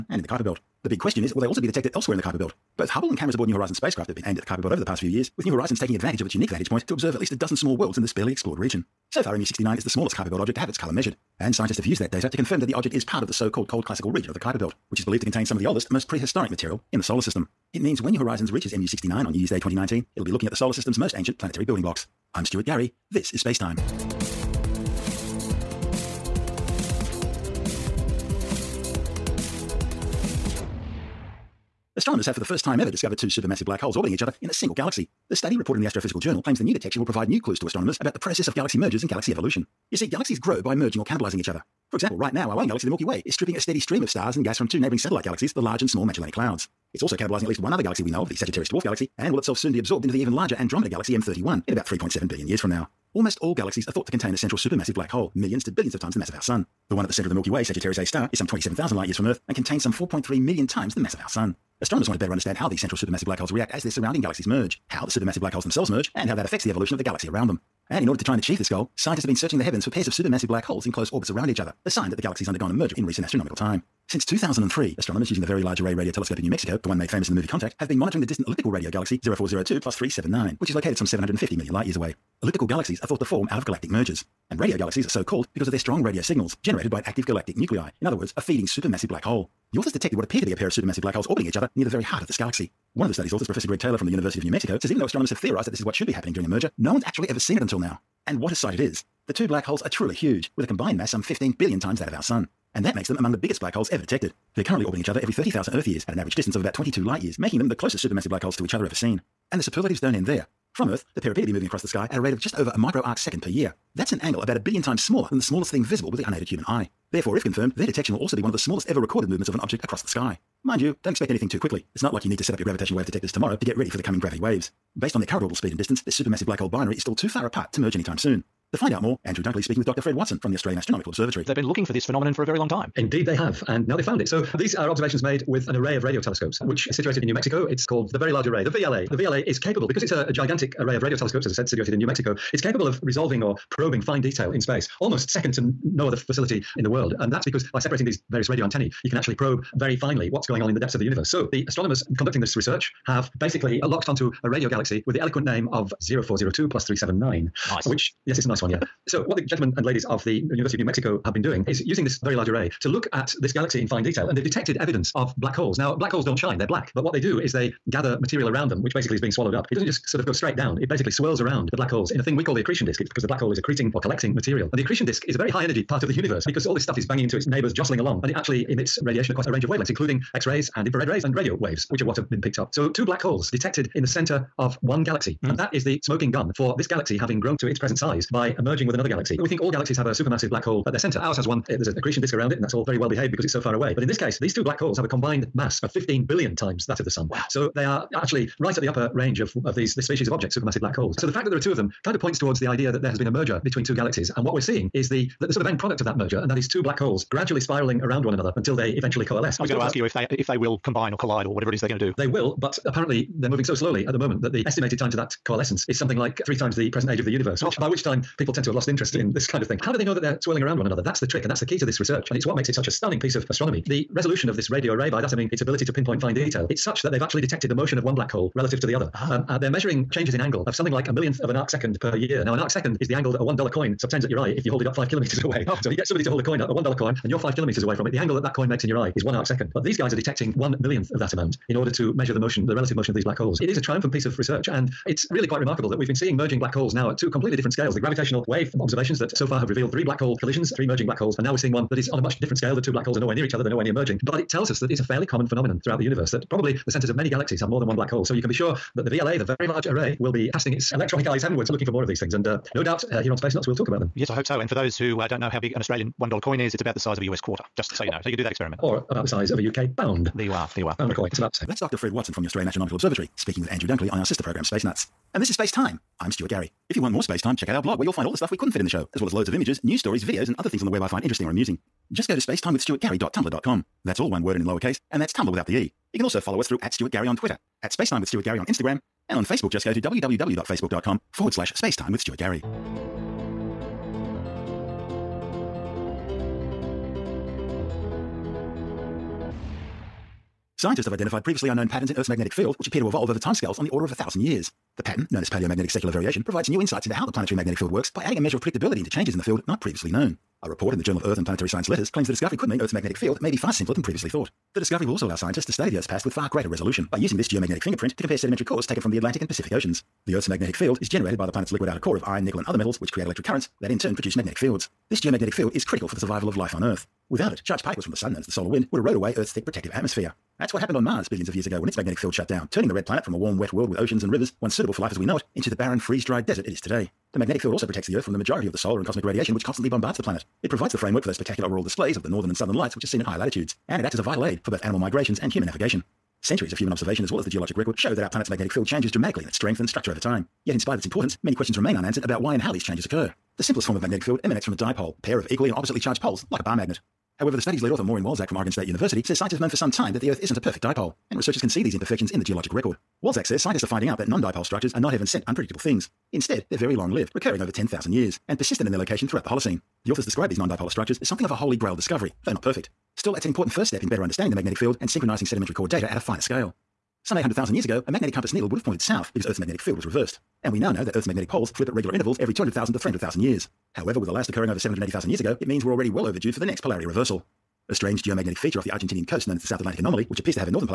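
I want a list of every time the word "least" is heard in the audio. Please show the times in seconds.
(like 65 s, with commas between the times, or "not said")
7 s, 47 s.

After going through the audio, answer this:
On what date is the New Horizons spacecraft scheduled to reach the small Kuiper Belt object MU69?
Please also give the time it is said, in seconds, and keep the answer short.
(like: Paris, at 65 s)
New Year's Day 2019, at 19 s.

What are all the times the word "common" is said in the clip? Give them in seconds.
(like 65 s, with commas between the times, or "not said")
255 s.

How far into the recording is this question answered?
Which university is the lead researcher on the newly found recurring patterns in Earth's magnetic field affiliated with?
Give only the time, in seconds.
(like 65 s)
358 s.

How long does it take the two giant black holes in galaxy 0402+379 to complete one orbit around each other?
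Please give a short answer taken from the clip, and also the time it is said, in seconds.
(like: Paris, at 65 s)
30,000 years, at 105 s.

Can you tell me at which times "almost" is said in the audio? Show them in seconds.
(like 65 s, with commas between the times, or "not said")
53 s, 145 s.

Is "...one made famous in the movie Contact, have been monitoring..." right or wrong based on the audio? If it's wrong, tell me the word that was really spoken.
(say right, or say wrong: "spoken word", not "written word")
right.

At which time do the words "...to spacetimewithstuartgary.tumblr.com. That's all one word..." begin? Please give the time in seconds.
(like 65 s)
282 s.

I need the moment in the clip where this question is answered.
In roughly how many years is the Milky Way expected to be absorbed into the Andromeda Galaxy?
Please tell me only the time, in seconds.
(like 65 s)
51 s.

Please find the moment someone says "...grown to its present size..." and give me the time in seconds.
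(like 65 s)
187 s.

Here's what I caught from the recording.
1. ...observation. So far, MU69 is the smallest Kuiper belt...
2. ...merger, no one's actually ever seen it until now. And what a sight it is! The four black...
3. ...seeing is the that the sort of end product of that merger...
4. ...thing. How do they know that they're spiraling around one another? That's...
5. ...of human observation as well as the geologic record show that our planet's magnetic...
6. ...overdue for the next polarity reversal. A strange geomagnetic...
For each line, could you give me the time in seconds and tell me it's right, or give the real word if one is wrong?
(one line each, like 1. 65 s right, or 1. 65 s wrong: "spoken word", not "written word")
1. 8 s wrong: "region", not "observation"
2. 96 s wrong: "two", not "four"
3. 204 s right
4. 219 s wrong: "swirling", not "spiraling"
5. 346 s right
6. 386 s right.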